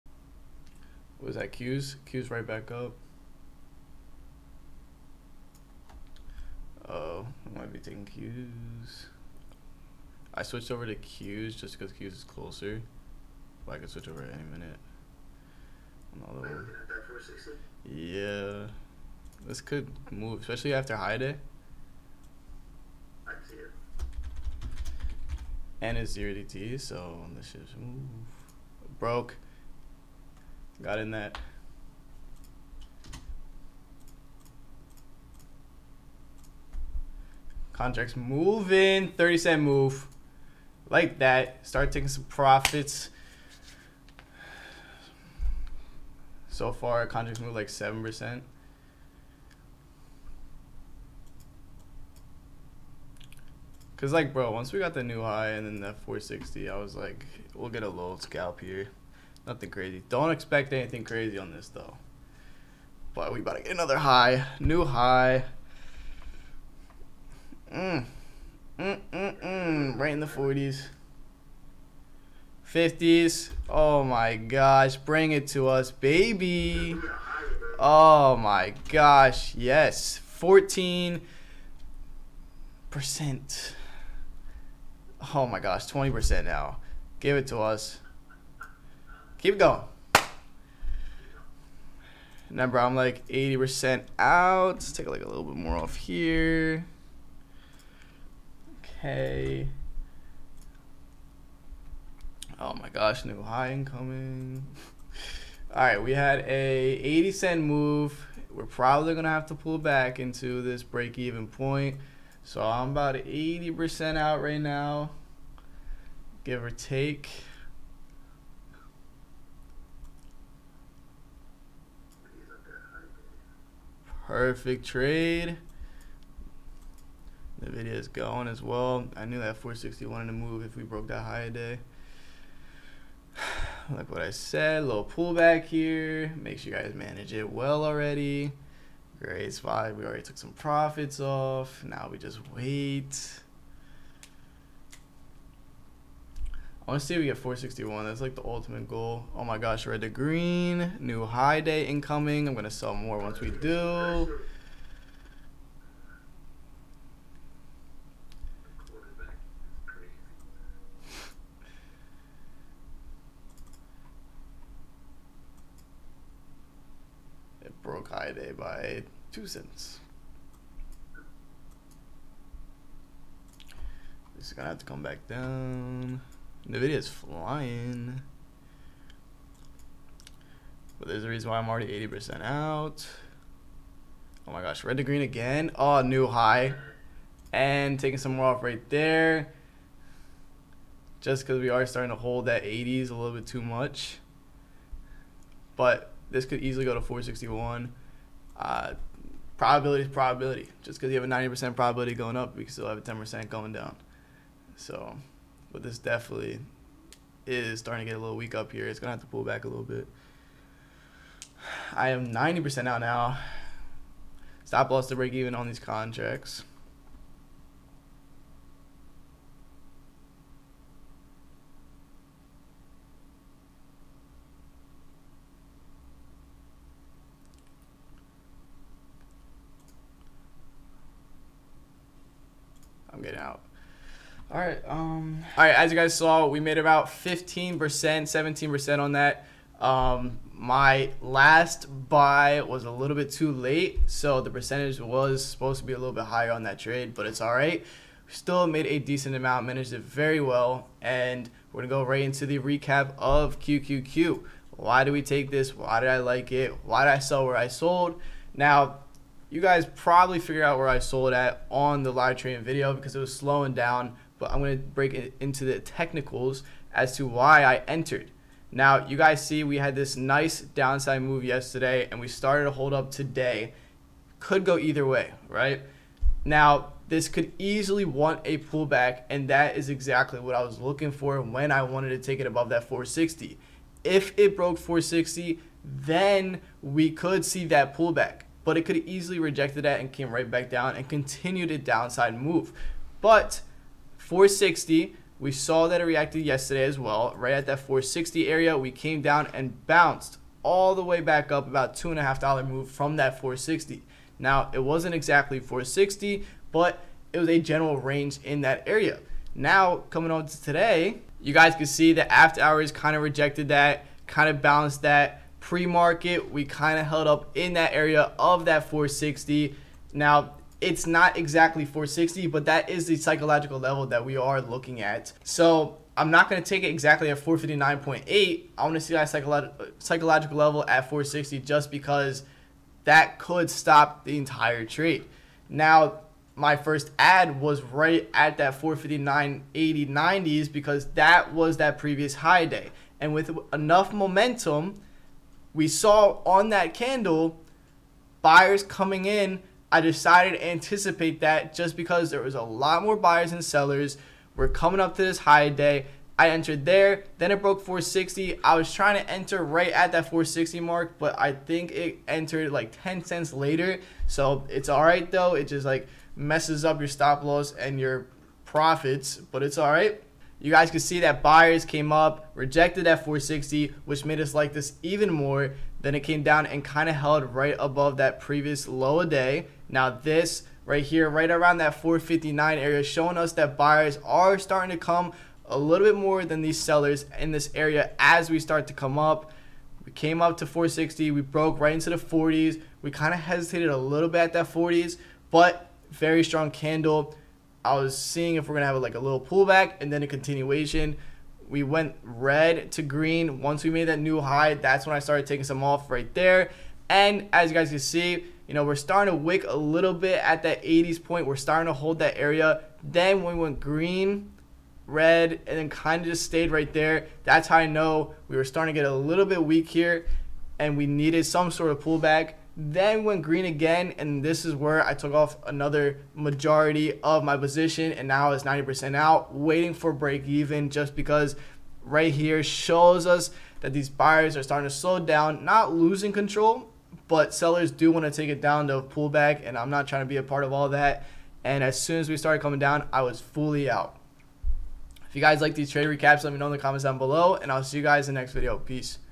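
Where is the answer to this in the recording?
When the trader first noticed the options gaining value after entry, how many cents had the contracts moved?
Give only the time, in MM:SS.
00:39.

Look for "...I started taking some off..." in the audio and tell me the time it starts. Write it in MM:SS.
06:45.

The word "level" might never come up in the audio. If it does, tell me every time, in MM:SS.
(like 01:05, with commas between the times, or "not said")
05:23, 05:30.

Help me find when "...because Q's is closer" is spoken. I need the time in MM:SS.
00:11.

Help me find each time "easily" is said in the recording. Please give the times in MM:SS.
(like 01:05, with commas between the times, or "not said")
03:16, 04:37, 04:48.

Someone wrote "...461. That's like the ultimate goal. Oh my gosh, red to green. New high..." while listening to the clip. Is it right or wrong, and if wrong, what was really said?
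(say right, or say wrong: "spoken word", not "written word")
right.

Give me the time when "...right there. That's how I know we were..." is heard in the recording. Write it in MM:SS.
06:56.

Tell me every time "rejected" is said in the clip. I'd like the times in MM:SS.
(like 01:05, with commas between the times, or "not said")
04:49, 05:13, 06:12.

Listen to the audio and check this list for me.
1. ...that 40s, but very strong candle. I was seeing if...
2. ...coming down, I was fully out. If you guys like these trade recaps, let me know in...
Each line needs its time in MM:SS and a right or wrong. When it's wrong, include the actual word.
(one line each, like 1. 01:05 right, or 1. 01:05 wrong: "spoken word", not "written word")
1. 06:34 right
2. 07:22 right.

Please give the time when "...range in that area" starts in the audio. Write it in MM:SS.
05:07.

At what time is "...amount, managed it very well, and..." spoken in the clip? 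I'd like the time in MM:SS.
04:09.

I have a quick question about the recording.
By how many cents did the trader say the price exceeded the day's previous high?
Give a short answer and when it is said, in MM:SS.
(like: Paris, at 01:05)
2 cents, at 02:49.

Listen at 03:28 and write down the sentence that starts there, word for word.
It's gonna have to pull back a little bit.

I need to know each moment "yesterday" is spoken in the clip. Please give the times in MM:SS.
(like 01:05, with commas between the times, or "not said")
04:31, 04:56.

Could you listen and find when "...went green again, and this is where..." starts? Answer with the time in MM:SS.
07:03.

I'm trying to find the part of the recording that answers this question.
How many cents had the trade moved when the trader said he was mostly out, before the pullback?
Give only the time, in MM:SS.
01:47.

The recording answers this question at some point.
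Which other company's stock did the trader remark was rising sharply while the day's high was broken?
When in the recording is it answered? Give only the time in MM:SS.
02:56.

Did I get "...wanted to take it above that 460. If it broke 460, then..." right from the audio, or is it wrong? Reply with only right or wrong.
right.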